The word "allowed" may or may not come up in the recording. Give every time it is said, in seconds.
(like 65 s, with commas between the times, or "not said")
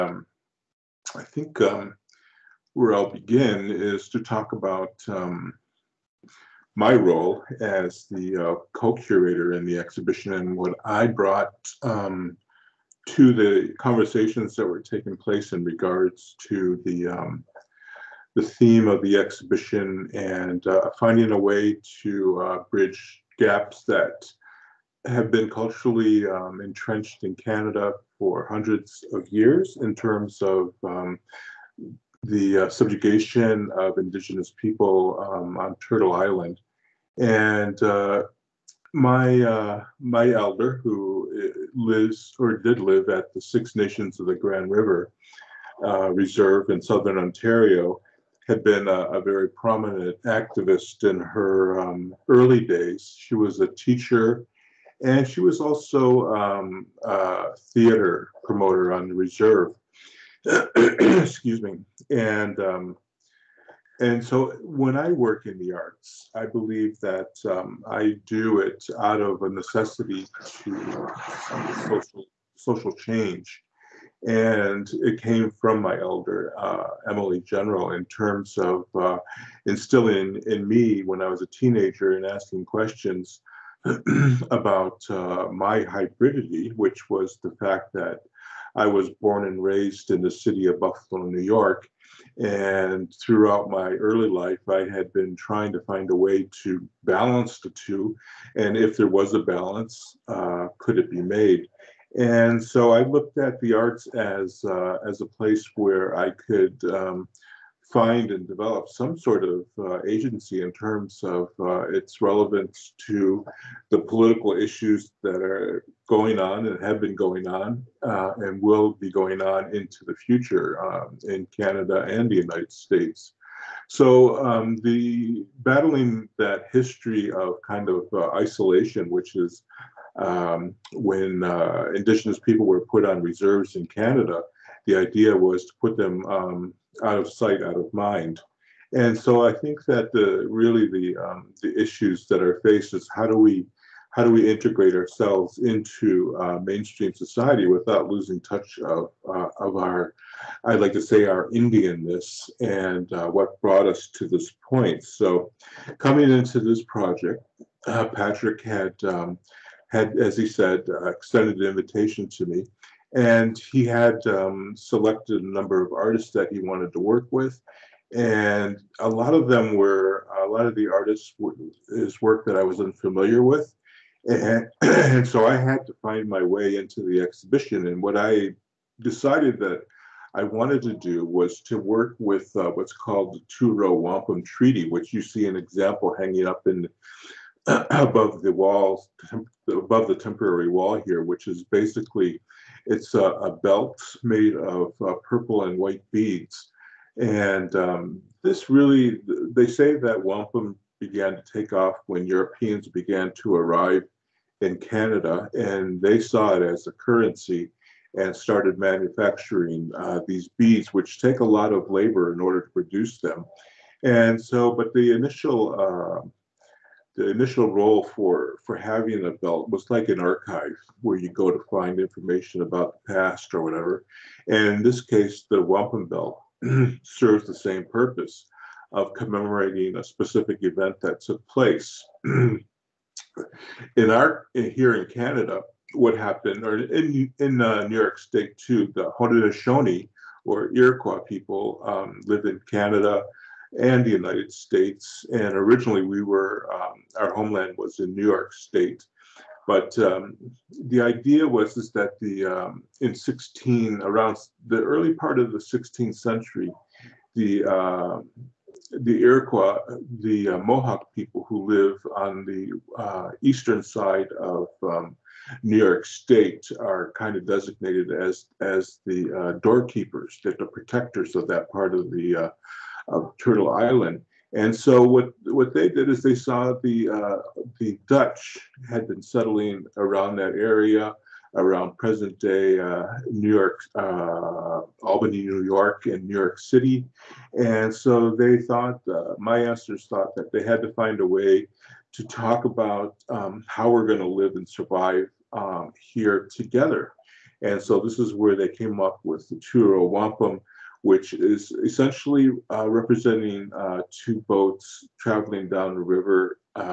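not said.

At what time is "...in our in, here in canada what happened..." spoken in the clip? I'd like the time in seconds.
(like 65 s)
232 s.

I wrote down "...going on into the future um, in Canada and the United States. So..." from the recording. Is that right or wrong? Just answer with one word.
right.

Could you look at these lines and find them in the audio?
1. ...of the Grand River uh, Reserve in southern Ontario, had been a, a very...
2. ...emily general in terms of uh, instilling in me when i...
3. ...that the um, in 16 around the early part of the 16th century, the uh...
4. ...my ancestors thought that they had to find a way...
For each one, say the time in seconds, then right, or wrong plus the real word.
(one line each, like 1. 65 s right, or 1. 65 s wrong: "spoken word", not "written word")
1. 44 s right
2. 77 s right
3. 251 s right
4. 289 s right.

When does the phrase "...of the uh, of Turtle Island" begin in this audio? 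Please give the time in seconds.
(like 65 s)
271 s.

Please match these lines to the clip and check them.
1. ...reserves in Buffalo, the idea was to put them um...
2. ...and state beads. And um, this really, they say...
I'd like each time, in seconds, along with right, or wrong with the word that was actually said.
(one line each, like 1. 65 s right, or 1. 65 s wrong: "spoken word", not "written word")
1. 133 s wrong: "Canada", not "Buffalo"
2. 195 s wrong: "white", not "state".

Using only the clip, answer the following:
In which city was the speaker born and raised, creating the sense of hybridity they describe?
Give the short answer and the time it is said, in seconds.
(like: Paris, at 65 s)
Buffalo, New York, at 90 s.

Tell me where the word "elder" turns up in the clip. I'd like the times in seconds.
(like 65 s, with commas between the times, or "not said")
40 s, 75 s.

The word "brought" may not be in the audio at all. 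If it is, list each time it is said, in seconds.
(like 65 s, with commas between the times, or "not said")
11 s, 153 s.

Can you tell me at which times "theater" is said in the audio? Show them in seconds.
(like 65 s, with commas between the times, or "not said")
57 s.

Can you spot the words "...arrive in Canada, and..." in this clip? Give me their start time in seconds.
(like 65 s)
203 s.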